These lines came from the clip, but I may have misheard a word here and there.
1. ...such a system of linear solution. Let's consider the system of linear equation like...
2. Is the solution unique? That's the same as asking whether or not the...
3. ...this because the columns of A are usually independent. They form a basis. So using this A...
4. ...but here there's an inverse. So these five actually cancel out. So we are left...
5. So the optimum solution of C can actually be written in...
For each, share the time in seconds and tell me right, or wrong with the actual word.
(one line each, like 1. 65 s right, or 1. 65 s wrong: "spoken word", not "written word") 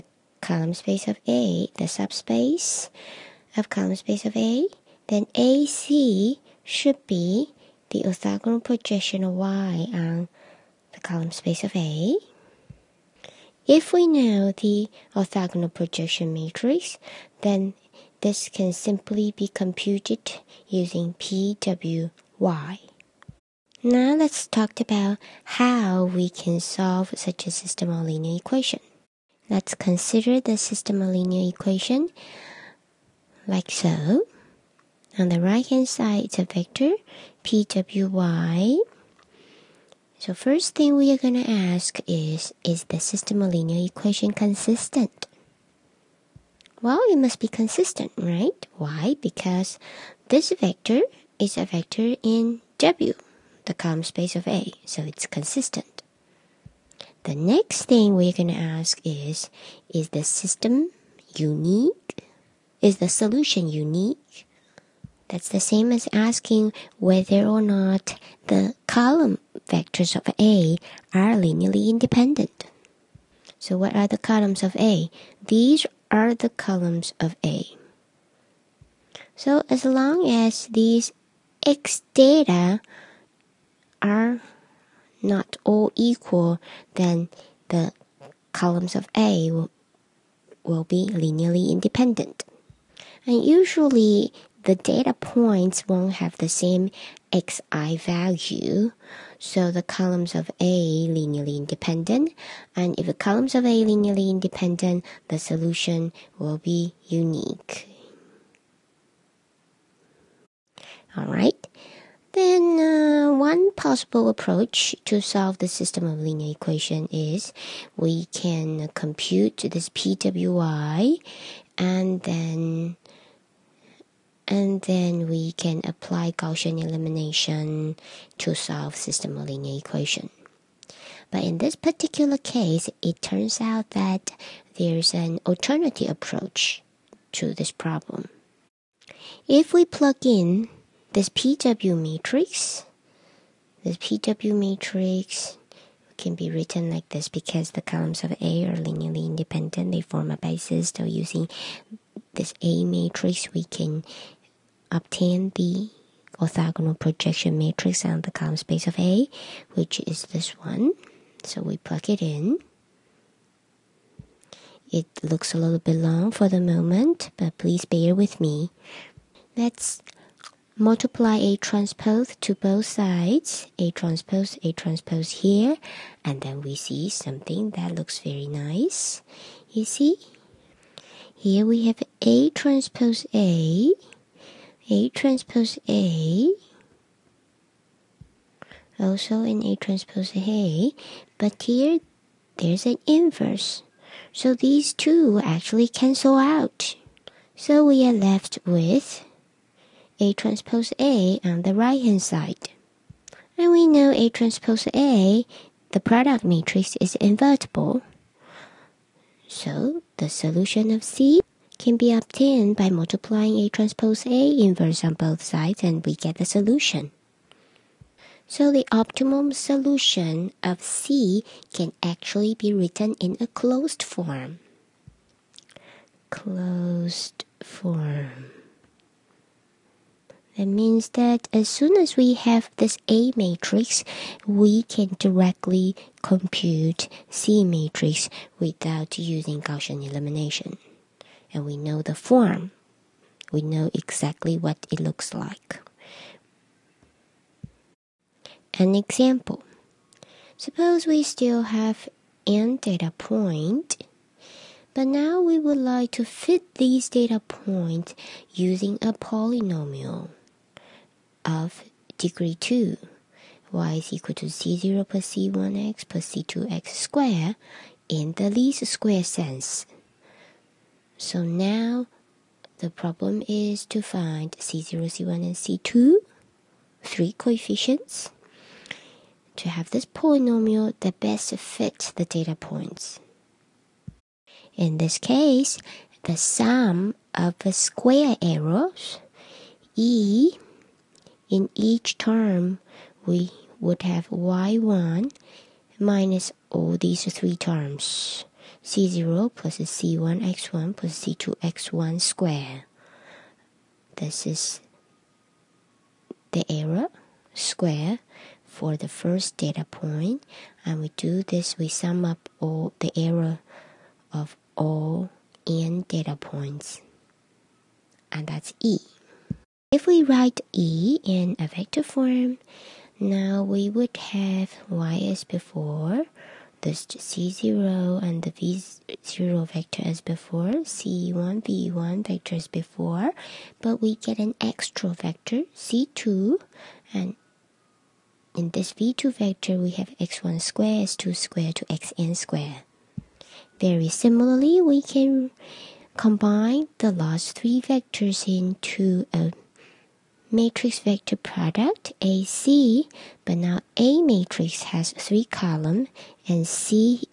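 1. 27 s wrong: "equation", not "solution"
2. 62 s right
3. 147 s wrong: "linearly", not "usually"
4. 191 s wrong: "two", not "five"
5. 218 s right.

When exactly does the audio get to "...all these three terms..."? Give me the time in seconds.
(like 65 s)
296 s.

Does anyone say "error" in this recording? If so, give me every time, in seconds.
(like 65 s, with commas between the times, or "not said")
288 s, 306 s, 313 s.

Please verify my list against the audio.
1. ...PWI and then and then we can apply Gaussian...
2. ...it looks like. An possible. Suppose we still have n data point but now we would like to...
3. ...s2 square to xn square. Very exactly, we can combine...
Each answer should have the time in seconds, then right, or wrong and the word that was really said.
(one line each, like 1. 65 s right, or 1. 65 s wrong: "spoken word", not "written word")
1. 119 s right
2. 244 s wrong: "example", not "possible"
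3. 341 s wrong: "similarly", not "exactly".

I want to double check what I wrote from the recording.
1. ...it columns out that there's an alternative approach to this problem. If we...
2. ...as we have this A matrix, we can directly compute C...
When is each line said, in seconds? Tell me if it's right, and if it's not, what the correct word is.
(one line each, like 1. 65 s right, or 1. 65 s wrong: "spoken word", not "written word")
1. 133 s wrong: "turns", not "columns"
2. 231 s right.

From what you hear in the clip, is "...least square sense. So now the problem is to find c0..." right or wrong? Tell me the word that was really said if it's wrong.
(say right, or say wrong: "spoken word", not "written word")
right.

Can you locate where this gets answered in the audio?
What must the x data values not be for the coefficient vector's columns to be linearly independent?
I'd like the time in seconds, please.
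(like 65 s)
85 s.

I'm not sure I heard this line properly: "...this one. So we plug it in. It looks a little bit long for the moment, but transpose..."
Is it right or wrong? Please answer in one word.
wrong.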